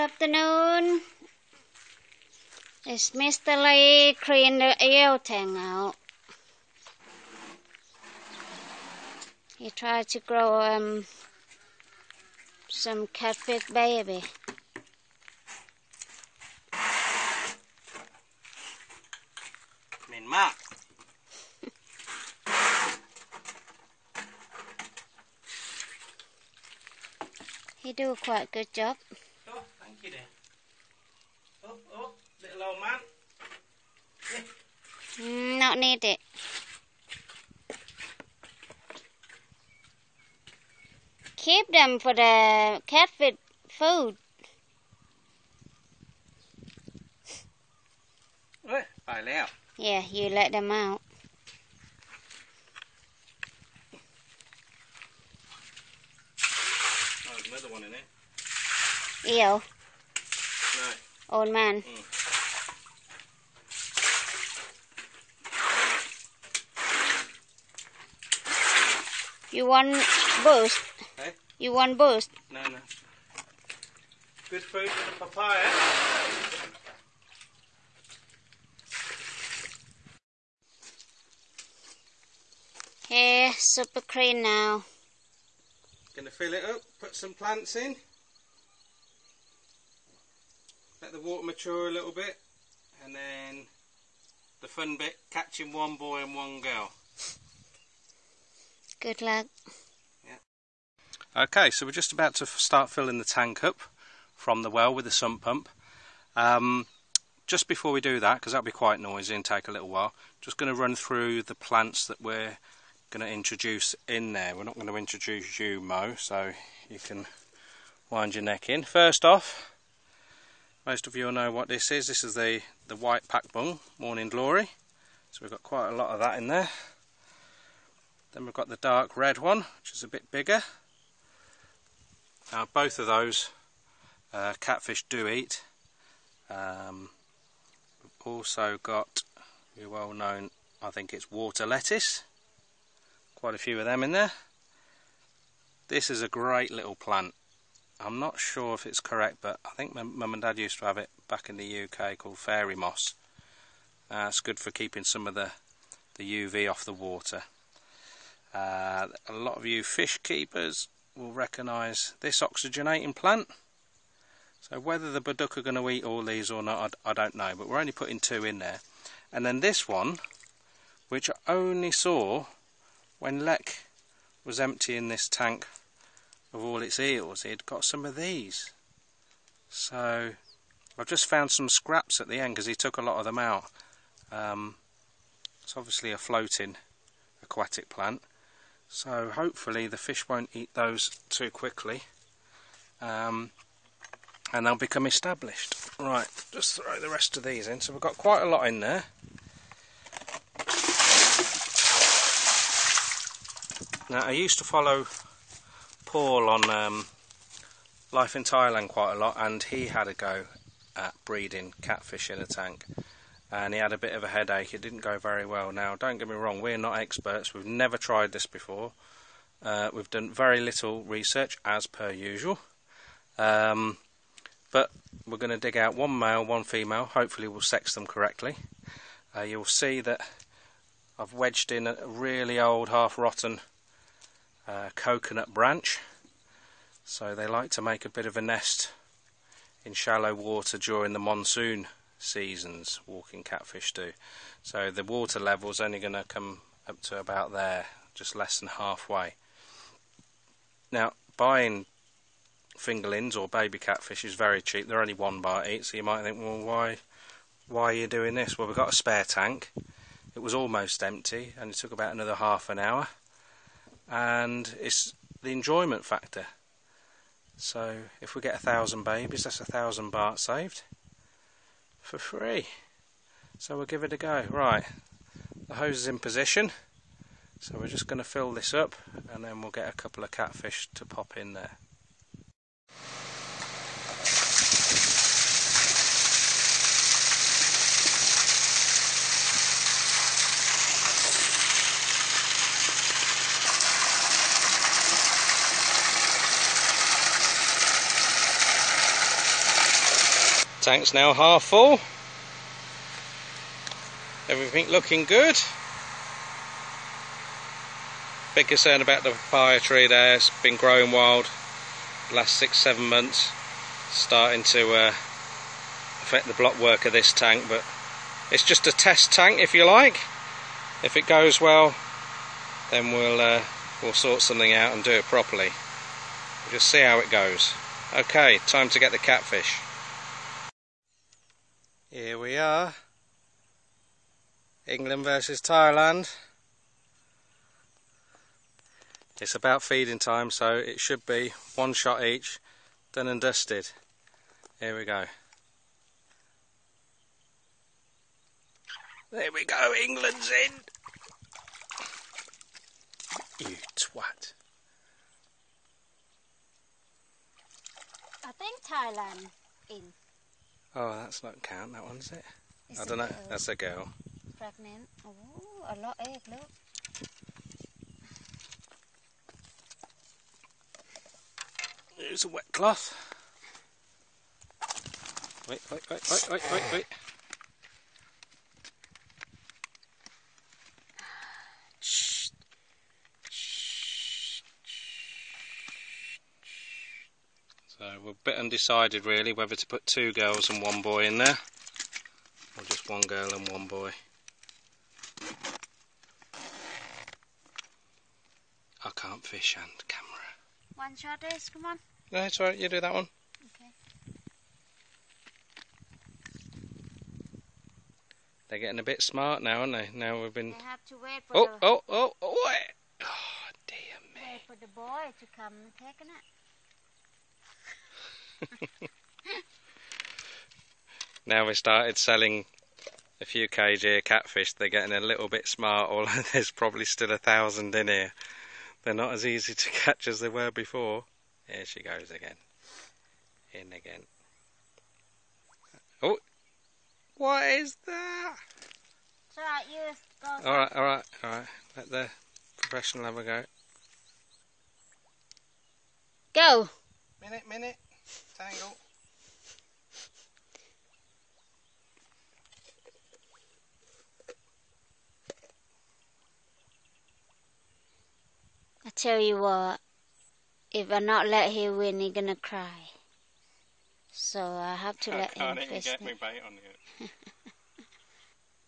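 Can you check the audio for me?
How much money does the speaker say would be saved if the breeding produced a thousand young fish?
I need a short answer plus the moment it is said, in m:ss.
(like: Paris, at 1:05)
1,000 baht, at 4:29.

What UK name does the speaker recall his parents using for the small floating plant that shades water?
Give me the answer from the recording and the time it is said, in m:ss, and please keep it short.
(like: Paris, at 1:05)
Fairy moss, at 2:32.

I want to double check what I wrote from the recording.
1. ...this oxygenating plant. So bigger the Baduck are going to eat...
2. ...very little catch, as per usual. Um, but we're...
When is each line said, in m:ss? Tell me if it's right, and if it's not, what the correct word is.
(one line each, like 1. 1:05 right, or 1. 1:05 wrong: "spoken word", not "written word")
1. 2:42 wrong: "whether", not "bigger"
2. 3:40 wrong: "research", not "catch".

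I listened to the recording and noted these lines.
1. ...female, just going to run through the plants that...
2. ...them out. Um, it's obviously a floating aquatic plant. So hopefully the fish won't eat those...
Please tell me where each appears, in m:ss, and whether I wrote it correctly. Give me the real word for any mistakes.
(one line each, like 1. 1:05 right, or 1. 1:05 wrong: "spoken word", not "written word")
1. 1:49 wrong: "while", not "female"
2. 3:03 right.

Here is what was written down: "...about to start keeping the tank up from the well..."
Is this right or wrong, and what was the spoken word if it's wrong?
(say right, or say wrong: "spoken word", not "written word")
wrong: "filling", not "keeping".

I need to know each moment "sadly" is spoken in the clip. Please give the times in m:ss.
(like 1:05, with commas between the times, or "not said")
not said.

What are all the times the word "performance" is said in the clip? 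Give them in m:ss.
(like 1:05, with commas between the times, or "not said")
not said.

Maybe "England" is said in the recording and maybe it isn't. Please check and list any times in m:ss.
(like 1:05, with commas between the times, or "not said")
5:34, 5:50.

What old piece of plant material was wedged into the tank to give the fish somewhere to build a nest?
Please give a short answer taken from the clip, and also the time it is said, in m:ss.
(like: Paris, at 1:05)
Coconut branch, at 3:54.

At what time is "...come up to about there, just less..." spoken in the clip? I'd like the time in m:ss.
4:06.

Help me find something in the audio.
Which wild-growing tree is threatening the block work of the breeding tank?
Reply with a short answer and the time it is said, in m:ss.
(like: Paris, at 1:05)
Papaya tree, at 5:09.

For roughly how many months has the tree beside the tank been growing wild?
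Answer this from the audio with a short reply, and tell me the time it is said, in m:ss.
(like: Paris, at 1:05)
6 or 7 months, at 5:12.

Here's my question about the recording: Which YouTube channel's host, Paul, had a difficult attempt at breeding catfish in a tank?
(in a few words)
Life in Thailand.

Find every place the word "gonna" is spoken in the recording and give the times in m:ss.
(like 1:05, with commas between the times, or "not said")
1:26, 7:42.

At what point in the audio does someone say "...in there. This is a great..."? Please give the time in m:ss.
2:24.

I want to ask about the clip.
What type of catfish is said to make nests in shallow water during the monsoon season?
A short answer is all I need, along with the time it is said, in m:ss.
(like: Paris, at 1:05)
Walking catfish, at 4:03.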